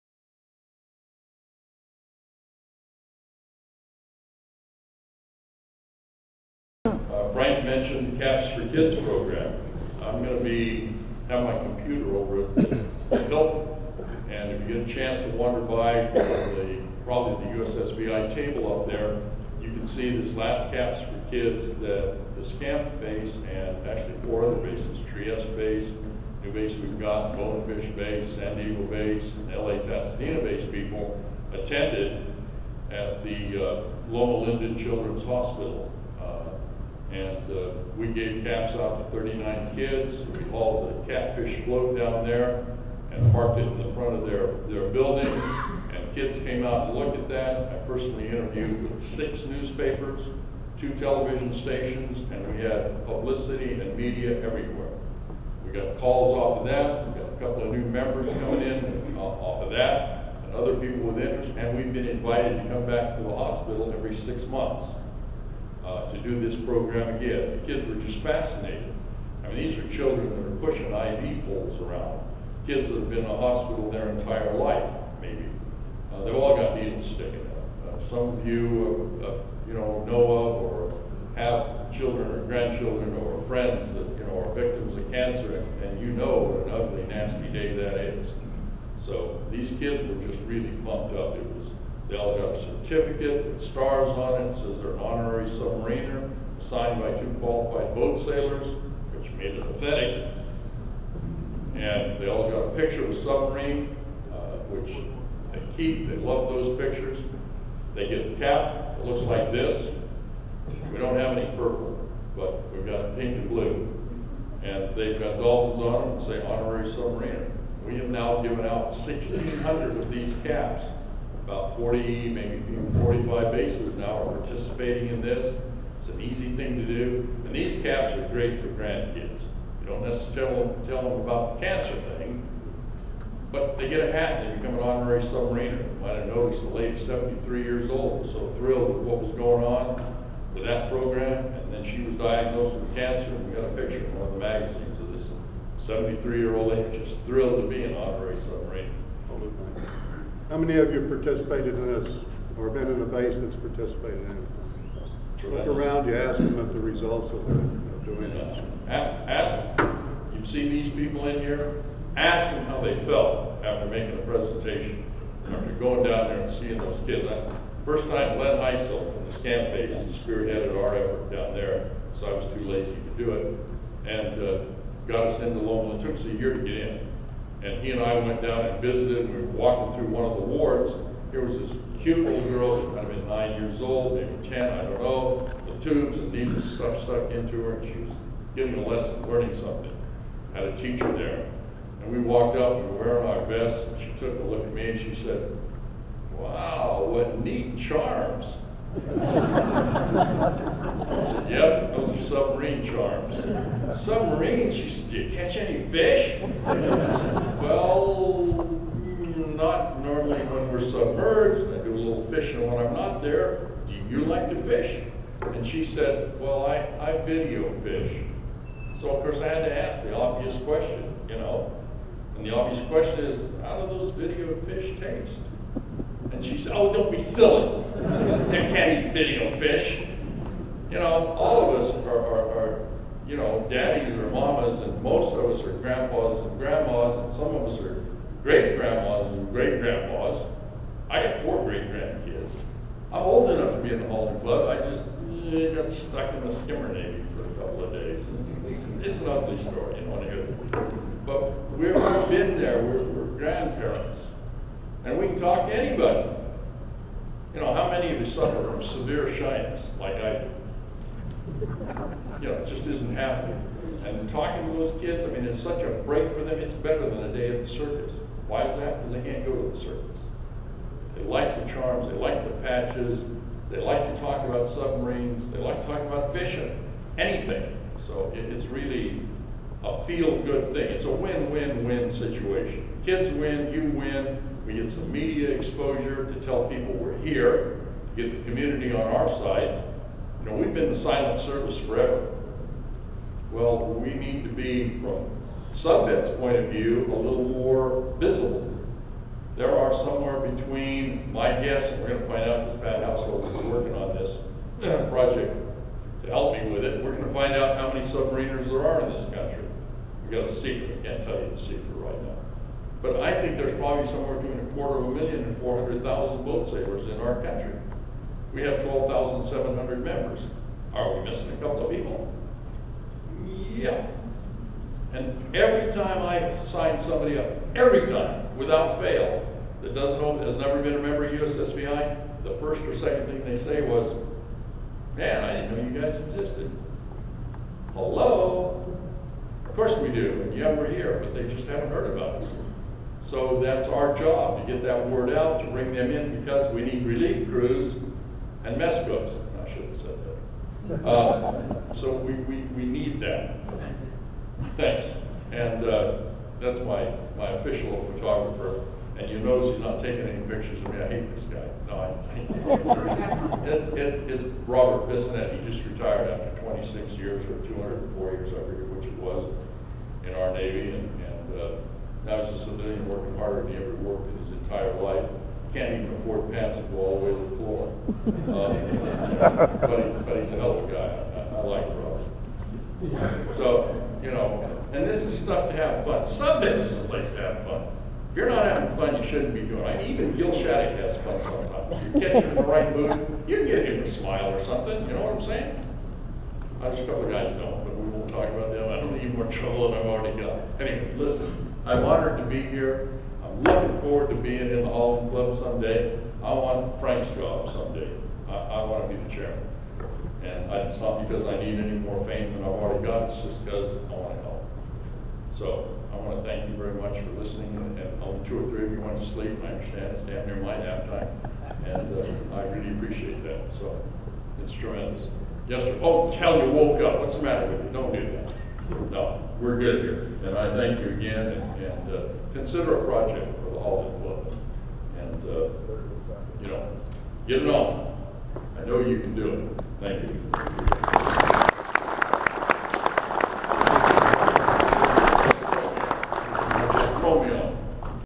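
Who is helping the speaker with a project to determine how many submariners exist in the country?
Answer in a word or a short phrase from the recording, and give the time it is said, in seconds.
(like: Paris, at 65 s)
Pat Householder, at 302 s.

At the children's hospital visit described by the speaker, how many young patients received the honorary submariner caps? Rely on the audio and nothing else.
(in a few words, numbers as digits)
39.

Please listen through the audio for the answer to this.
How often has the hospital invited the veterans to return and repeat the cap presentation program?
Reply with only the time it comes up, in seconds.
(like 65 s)
63 s.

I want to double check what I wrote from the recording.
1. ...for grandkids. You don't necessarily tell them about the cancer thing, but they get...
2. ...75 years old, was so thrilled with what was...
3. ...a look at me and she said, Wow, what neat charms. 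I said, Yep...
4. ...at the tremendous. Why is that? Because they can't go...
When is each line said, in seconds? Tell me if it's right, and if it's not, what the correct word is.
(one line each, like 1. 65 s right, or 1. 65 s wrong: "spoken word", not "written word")
1. 128 s right
2. 136 s wrong: "73", not "75"
3. 194 s right
4. 267 s wrong: "circus", not "tremendous".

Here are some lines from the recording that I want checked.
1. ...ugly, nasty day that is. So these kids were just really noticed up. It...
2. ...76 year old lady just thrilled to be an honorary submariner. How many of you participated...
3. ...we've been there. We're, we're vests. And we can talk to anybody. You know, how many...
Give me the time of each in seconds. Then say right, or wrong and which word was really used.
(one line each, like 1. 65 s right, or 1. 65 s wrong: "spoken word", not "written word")
1. 86 s wrong: "pumped", not "noticed"
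2. 145 s wrong: "73", not "76"
3. 251 s wrong: "grandparents", not "vests".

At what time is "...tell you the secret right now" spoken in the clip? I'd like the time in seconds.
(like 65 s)
311 s.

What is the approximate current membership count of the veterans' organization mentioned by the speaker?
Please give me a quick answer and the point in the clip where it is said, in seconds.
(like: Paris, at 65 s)
12,700, at 318 s.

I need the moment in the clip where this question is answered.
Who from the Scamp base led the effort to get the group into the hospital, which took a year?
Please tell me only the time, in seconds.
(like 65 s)
168 s.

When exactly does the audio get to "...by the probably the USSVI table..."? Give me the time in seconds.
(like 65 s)
15 s.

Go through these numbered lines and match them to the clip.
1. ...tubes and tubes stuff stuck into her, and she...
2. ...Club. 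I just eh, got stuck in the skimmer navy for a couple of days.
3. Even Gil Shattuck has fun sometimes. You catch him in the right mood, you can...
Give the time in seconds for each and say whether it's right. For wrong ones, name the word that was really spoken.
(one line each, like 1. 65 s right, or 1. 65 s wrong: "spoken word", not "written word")
1. 185 s wrong: "needles", not "tubes"
2. 244 s right
3. 390 s right.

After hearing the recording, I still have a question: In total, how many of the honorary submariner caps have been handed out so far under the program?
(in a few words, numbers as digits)
1,600.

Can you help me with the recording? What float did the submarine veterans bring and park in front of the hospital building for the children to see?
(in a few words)
catfish float.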